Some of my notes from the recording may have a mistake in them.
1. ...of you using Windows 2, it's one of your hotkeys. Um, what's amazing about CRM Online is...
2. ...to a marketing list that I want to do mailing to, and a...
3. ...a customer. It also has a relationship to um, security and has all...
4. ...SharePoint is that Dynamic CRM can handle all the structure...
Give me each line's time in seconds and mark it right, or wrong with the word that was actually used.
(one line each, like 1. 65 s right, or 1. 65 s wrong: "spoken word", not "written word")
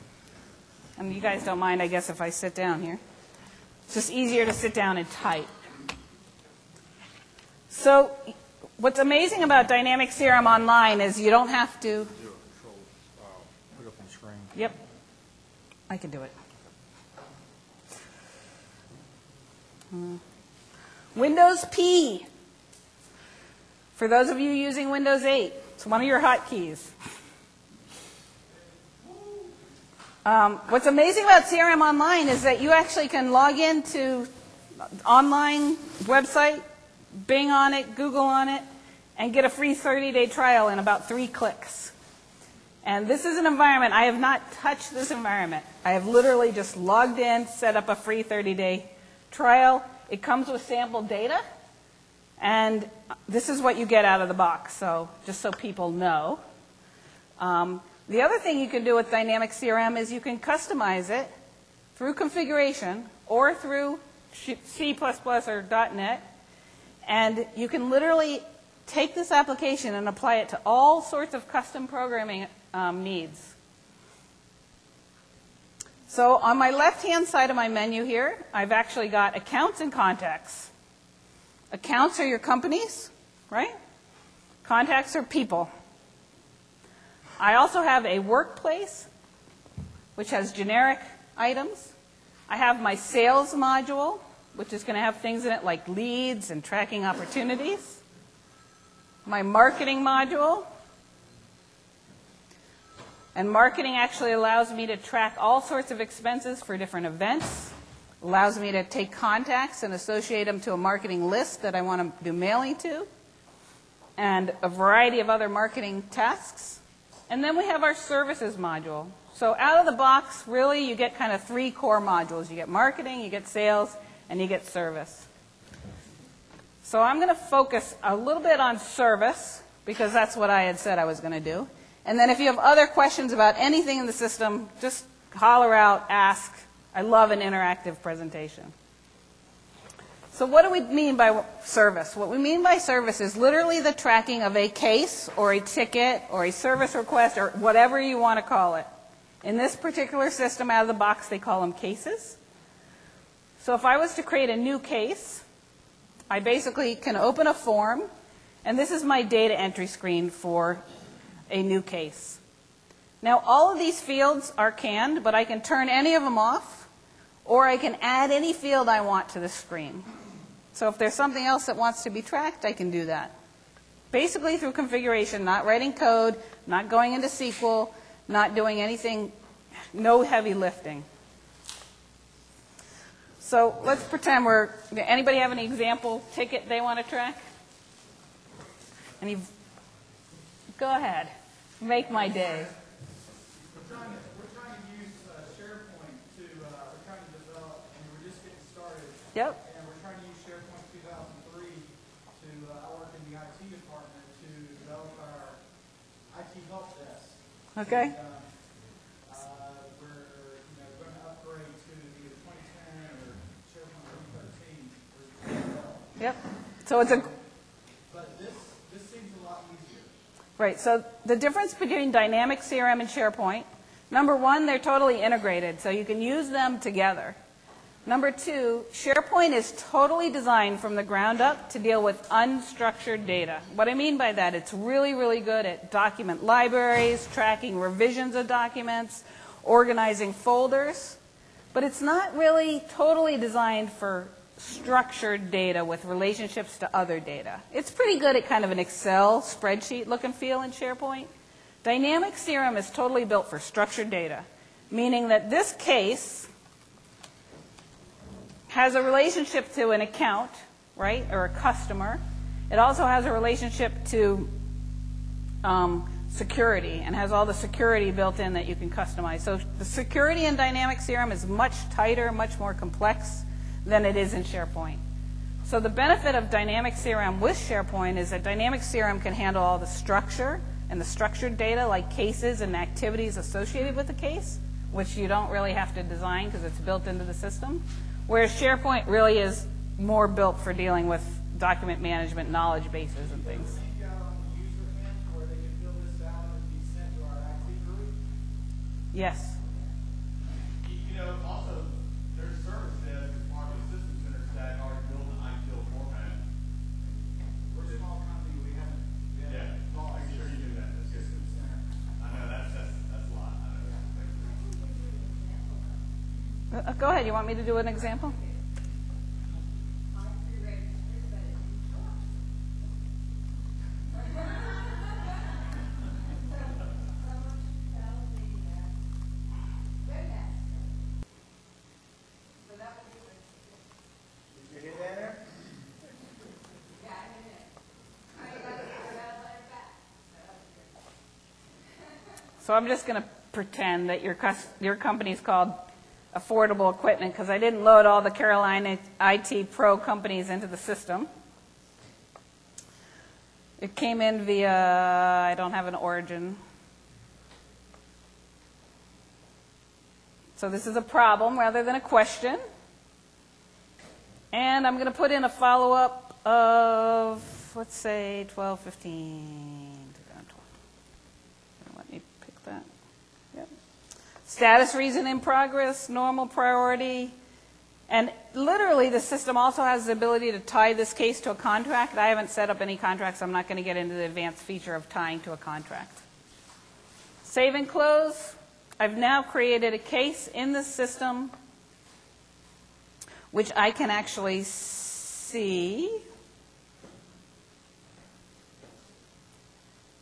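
1. 24 s wrong: "8", not "2"
2. 110 s right
3. 261 s right
4. 277 s right.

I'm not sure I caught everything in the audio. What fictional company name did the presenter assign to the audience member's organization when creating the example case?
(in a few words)
Affordable Equipment.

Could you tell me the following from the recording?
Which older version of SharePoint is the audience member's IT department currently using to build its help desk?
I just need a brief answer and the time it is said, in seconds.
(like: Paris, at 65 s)
SharePoint 2003, at 200 s.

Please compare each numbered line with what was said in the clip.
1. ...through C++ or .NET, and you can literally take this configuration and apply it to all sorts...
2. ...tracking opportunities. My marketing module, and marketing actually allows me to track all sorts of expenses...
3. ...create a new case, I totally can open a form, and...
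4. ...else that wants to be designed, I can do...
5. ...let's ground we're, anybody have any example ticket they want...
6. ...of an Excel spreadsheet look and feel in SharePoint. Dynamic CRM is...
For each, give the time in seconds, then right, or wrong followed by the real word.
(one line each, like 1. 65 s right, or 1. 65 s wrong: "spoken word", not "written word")
1. 63 s wrong: "application", not "configuration"
2. 96 s right
3. 154 s wrong: "basically", not "totally"
4. 171 s wrong: "tracked", not "designed"
5. 183 s wrong: "pretend", not "ground"
6. 248 s right.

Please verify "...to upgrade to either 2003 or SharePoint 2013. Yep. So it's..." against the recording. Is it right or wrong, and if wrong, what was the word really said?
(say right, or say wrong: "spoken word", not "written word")
wrong: "2010", not "2003".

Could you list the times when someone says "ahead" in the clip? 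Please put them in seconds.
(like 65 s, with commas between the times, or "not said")
190 s, 317 s.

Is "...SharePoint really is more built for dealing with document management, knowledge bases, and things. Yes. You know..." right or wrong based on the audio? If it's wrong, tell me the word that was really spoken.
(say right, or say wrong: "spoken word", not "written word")
right.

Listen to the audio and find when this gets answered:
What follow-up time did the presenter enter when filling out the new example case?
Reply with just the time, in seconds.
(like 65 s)
368 s.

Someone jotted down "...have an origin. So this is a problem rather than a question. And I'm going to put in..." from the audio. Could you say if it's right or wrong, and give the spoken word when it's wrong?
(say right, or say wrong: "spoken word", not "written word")
right.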